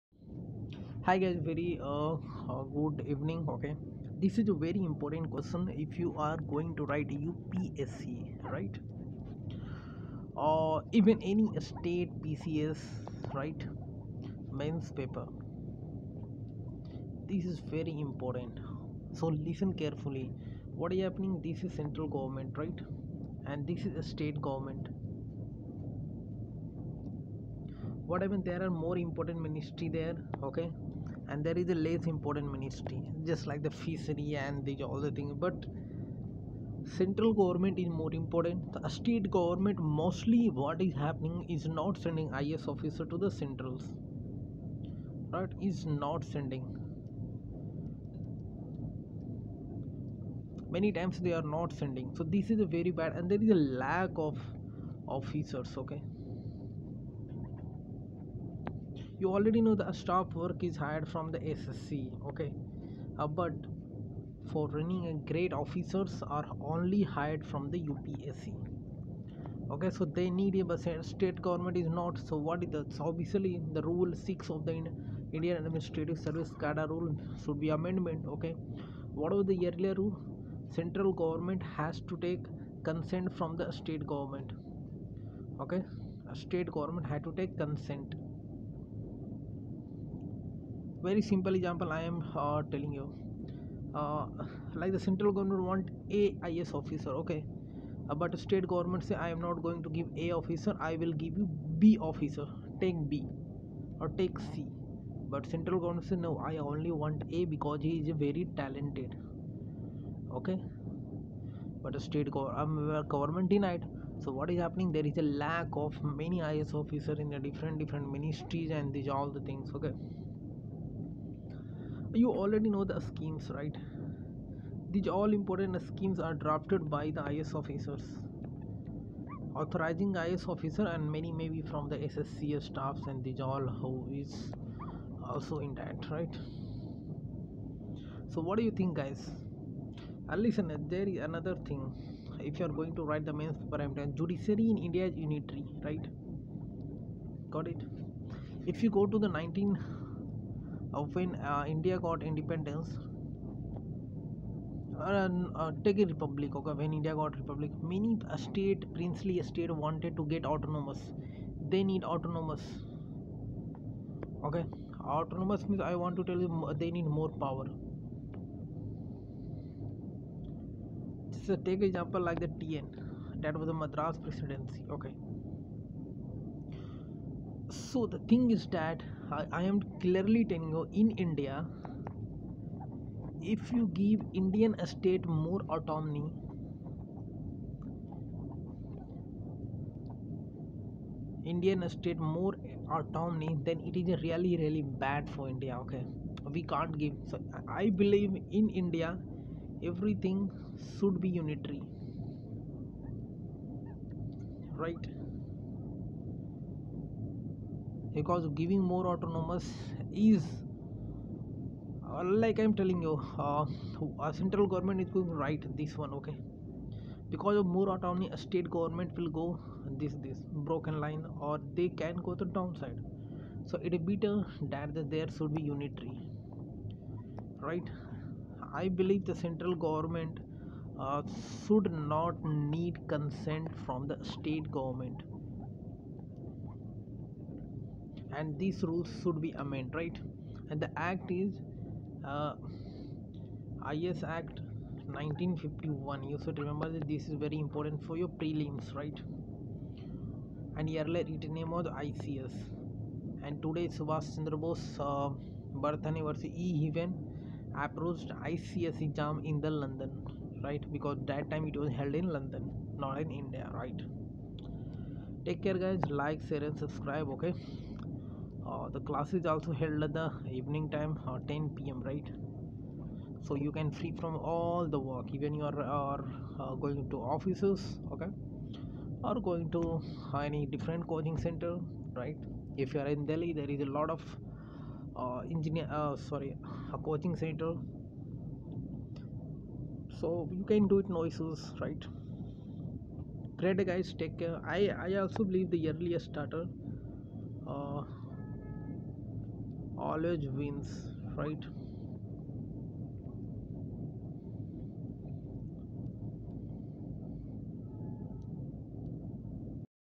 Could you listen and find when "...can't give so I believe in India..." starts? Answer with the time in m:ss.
3:16.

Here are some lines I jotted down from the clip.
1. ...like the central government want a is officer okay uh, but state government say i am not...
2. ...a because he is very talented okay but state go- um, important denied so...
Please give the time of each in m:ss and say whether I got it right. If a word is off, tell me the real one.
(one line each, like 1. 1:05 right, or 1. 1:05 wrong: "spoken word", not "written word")
1. 1:34 right
2. 1:47 wrong: "government", not "important".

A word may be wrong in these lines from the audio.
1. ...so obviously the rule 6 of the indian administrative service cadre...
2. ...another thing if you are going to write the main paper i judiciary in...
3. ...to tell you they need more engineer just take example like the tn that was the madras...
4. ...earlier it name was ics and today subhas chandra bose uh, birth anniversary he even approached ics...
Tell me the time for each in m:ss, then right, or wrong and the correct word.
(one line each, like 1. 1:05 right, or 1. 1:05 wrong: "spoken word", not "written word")
1. 1:12 right
2. 2:21 right
3. 2:46 wrong: "power", not "engineer"
4. 4:11 right.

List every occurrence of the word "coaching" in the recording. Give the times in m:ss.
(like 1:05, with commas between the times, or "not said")
4:41, 4:46.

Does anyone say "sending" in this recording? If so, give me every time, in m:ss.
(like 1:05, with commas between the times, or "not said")
0:42, 0:46, 0:51.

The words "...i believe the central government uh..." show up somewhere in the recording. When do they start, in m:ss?
3:48.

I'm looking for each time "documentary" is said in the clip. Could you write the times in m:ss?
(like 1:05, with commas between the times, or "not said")
not said.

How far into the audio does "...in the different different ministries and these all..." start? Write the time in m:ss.
1:57.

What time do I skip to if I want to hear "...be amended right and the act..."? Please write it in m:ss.
3:59.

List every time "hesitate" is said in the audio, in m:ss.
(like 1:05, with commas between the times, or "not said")
not said.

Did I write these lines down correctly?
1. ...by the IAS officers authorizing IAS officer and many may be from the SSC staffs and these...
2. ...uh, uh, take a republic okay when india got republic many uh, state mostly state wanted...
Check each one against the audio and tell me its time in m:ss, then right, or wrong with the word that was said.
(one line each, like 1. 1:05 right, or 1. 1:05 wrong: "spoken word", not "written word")
1. 2:06 right
2. 2:34 wrong: "princely", not "mostly".